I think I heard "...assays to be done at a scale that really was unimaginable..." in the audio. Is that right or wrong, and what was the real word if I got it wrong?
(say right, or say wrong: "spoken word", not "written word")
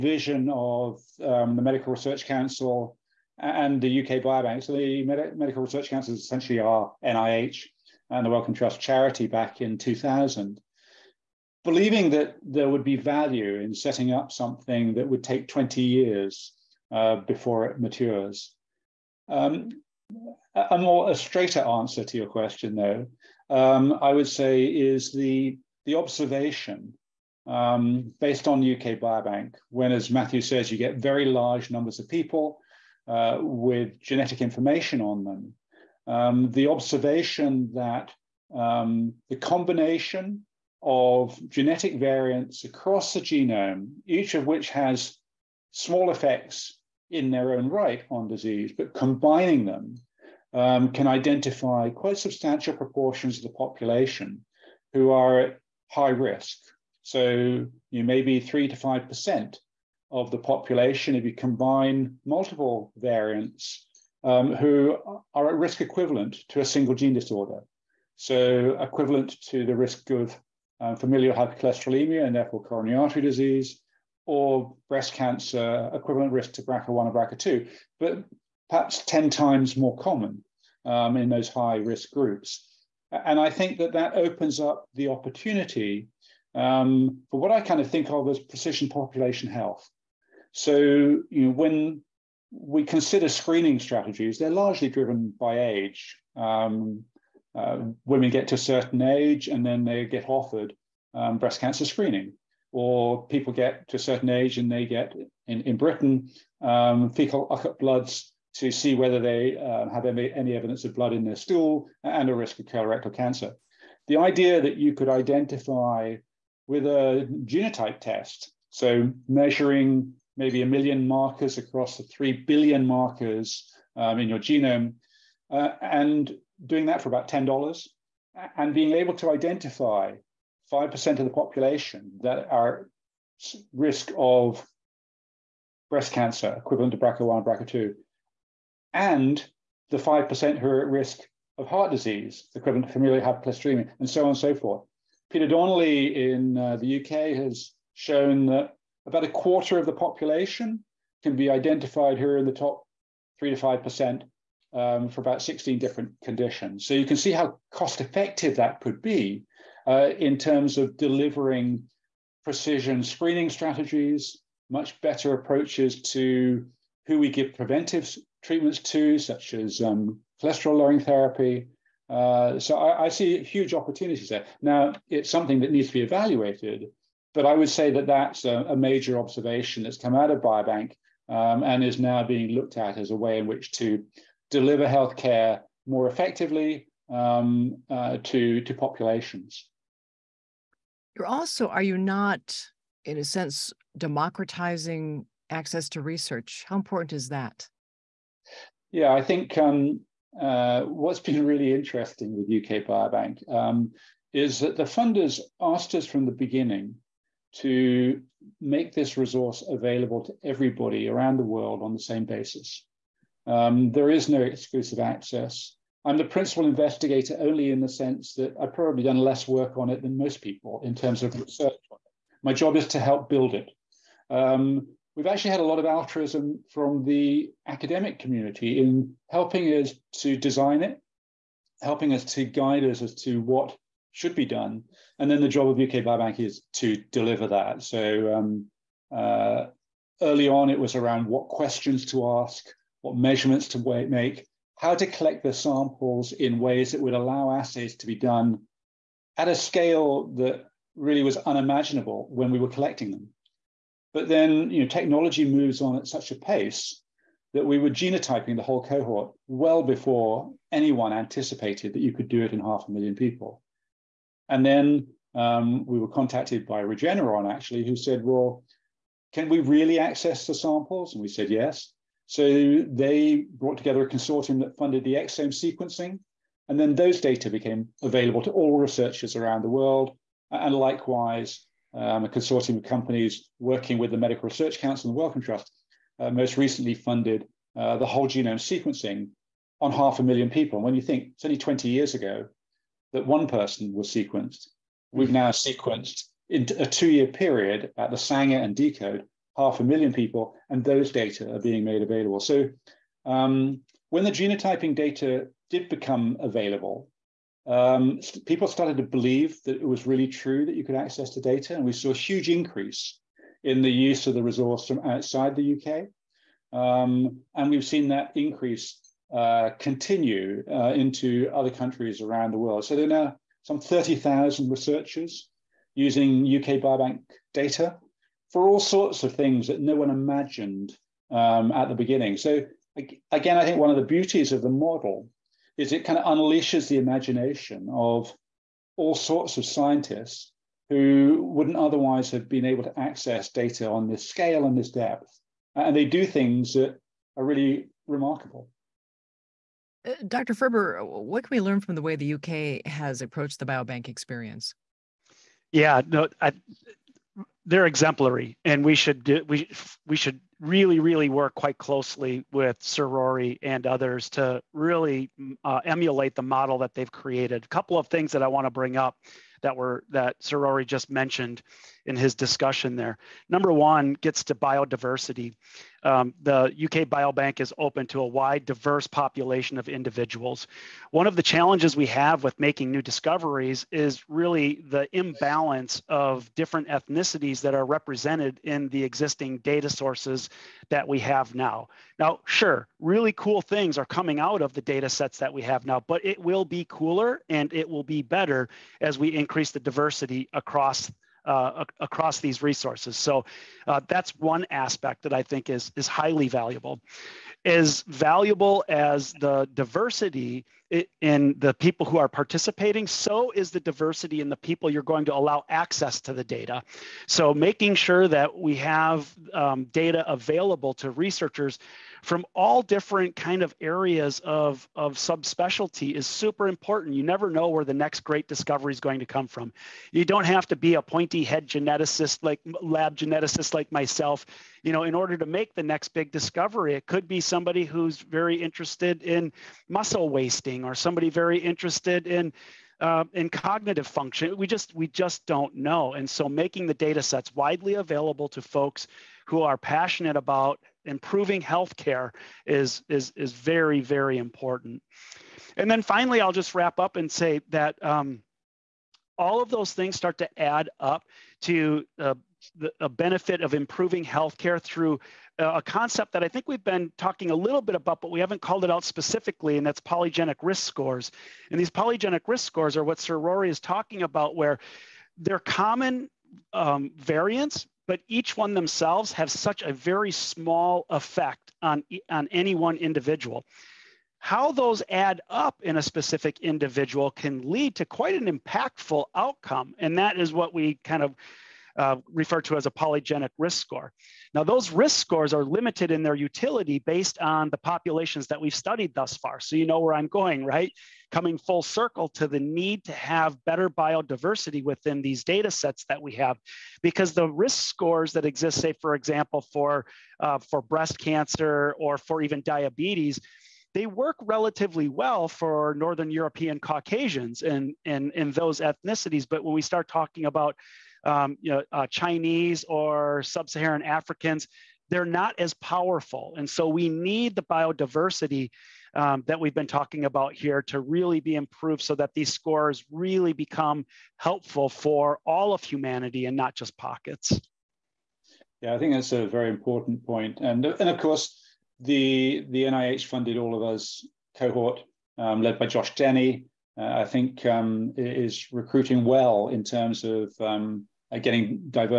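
right.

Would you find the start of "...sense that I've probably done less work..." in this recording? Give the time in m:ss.
3:37.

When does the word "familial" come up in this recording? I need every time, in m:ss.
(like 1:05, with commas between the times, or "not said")
1:10, 2:22.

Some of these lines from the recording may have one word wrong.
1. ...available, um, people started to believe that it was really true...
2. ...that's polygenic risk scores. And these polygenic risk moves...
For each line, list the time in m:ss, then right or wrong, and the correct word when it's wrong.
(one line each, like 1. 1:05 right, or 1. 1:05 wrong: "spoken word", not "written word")
1. 5:06 right
2. 7:49 wrong: "scores", not "moves".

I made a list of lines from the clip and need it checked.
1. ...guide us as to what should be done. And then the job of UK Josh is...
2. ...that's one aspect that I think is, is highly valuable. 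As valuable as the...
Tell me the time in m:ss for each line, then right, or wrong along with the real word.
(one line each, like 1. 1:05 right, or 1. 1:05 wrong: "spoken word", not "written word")
1. 3:52 wrong: "Biobank", not "Josh"
2. 6:44 right.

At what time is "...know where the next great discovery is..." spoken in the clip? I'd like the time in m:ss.
7:07.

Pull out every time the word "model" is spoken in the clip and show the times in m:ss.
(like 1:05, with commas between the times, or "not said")
5:34, 6:06.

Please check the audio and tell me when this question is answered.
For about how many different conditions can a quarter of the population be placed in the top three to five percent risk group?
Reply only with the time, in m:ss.
2:35.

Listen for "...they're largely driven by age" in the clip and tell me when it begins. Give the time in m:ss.
1:34.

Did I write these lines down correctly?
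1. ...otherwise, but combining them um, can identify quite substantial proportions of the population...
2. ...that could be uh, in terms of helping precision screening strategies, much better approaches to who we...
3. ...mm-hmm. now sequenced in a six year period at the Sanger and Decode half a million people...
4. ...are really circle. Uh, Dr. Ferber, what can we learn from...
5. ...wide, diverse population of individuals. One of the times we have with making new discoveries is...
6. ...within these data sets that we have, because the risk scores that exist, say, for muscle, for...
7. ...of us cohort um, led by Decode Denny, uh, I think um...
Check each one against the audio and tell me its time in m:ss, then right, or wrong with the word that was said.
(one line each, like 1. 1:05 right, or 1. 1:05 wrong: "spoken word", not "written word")
1. 0:48 wrong: "disease", not "otherwise"
2. 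2:38 wrong: "delivering", not "helping"
3. 4:55 wrong: "two", not "six"
4. 5:47 wrong: "remarkable", not "circle"
5. 6:18 wrong: "challenges", not "times"
6. 8:24 wrong: "example", not "muscle"
7. 9:03 wrong: "Josh", not "Decode".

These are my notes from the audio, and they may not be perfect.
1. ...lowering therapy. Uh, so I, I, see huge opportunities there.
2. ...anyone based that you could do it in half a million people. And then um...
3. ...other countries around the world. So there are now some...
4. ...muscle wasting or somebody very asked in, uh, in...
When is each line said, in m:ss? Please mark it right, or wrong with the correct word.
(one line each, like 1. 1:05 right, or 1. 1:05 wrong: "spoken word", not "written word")
1. 2:50 right
2. 4:20 wrong: "anticipated", not "based"
3. 5:21 right
4. 7:19 wrong: "interested", not "asked".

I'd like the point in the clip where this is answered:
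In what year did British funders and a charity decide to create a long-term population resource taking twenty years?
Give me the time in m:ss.
0:09.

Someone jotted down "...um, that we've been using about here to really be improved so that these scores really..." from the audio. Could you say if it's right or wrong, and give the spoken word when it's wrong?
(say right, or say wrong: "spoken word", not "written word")
wrong: "talking", not "using".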